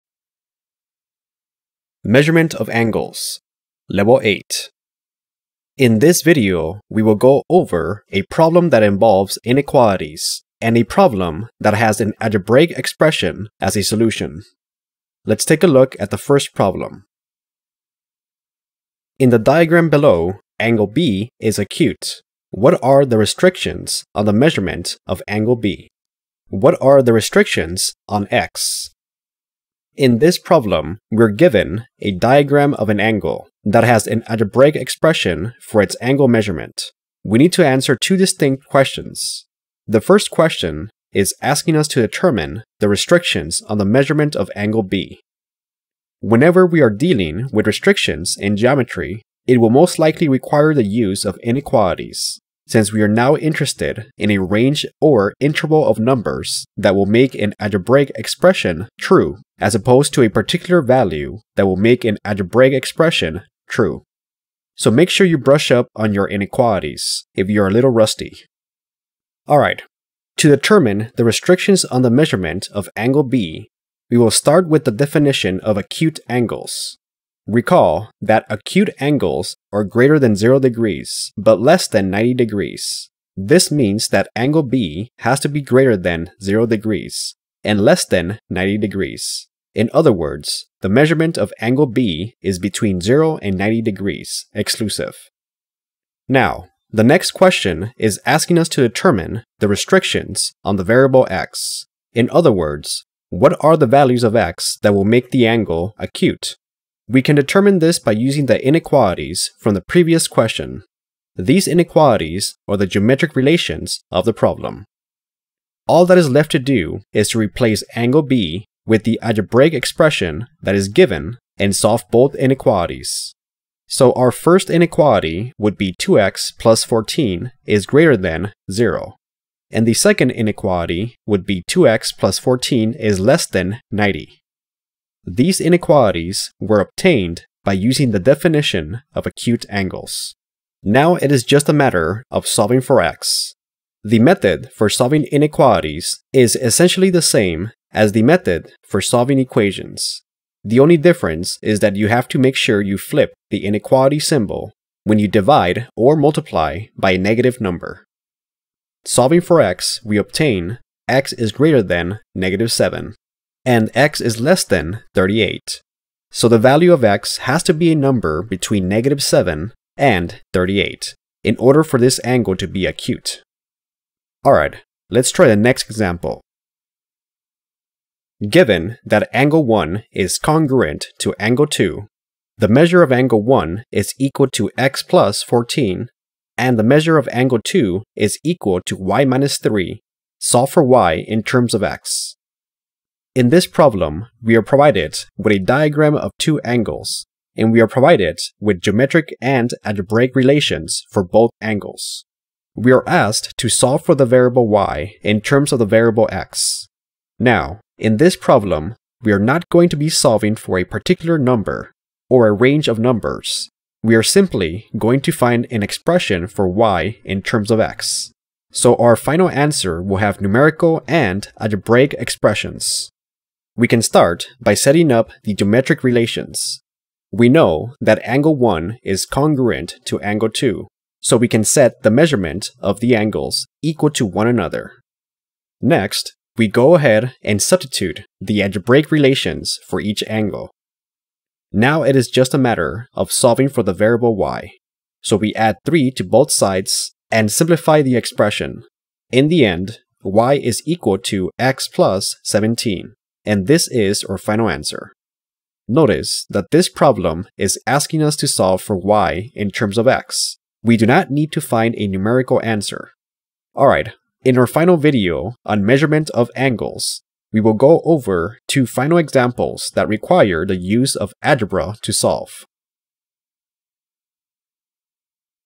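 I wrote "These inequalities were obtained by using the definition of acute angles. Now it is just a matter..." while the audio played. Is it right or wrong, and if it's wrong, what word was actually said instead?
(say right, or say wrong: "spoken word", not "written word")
right.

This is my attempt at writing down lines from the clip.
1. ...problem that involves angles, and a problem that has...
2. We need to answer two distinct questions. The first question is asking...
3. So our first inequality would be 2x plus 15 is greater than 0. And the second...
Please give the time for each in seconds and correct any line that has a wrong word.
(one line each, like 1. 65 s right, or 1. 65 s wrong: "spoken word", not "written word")
1. 8 s wrong: "inequalities", not "angles"
2. 37 s right
3. 123 s wrong: "14", not "15".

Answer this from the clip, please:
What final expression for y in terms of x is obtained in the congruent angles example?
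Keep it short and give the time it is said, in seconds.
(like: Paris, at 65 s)
x + 17, at 251 s.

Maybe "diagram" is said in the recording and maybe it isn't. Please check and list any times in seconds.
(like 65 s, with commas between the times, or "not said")
19 s, 32 s, 195 s.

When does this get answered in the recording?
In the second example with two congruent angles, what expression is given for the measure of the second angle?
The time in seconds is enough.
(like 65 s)
188 s.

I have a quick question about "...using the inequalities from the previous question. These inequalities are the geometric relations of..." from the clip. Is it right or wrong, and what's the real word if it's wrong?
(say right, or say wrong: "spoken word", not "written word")
right.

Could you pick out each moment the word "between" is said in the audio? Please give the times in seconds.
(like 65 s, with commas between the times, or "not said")
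92 s, 168 s.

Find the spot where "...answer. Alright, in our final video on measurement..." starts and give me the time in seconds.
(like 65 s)
262 s.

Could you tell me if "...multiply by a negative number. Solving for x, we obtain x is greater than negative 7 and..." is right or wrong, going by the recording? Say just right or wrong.
right.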